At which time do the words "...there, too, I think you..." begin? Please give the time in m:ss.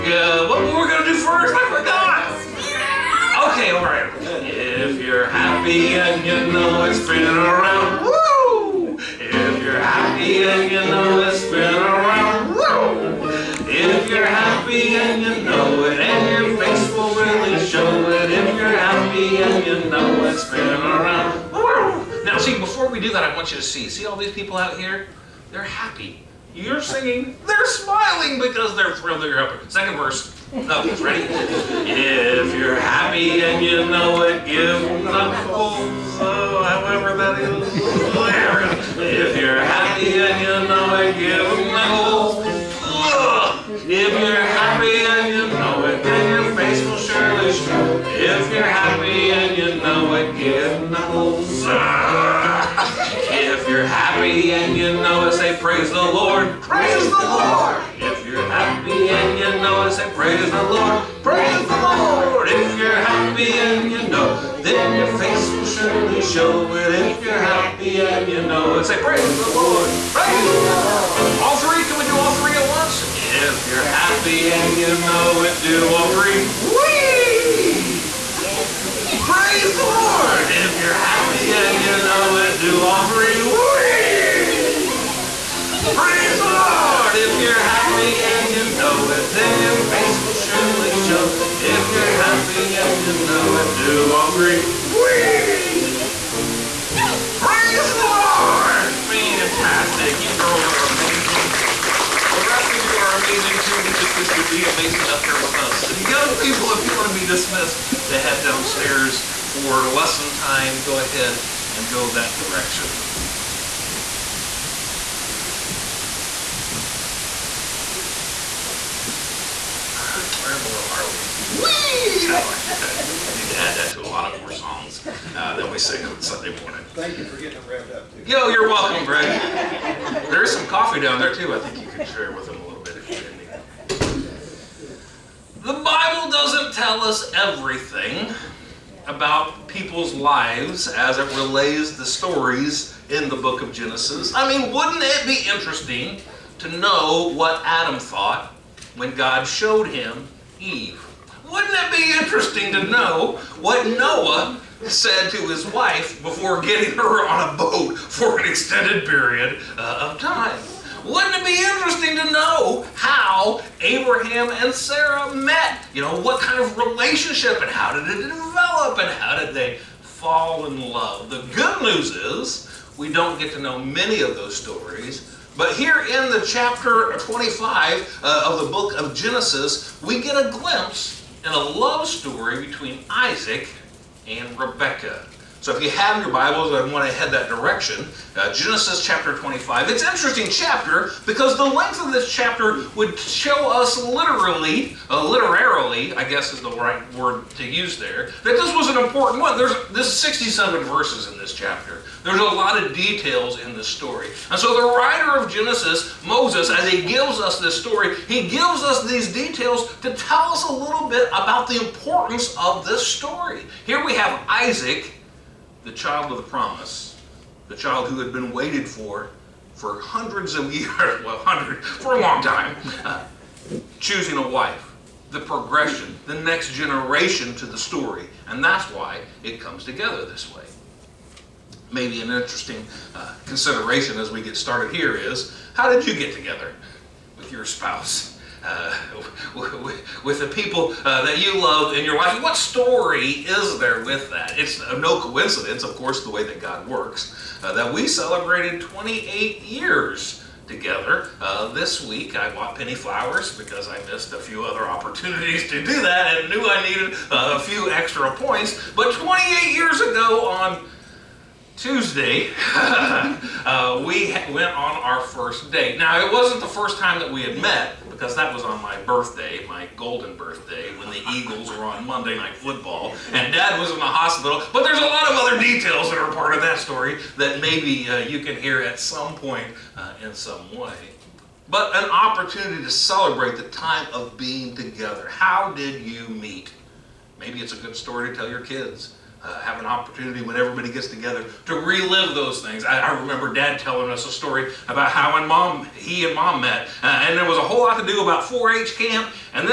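2:11.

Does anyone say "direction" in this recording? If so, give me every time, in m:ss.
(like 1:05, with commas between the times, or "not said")
1:52, 3:07.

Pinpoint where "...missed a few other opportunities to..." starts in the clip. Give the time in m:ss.
4:14.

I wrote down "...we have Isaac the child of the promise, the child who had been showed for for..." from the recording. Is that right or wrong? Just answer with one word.
wrong.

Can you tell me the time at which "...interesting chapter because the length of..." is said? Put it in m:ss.
3:10.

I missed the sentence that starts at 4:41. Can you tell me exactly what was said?
But an opportunity to celebrate the time of being together.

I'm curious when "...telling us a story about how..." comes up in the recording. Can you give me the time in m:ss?
4:53.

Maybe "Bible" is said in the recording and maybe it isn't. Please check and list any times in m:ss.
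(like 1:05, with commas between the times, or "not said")
2:15, 3:06.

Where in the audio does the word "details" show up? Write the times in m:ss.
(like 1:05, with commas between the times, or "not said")
3:22, 3:29, 4:35.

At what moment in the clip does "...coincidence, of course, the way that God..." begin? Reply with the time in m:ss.
4:05.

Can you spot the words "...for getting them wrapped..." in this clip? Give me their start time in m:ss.
2:07.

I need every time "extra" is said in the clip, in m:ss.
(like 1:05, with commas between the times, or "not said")
4:17.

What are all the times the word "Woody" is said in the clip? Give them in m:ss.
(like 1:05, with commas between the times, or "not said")
not said.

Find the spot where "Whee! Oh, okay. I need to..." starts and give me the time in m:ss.
2:01.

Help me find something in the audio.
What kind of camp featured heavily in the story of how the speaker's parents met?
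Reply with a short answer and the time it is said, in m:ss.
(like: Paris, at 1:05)
4-H camp, at 4:58.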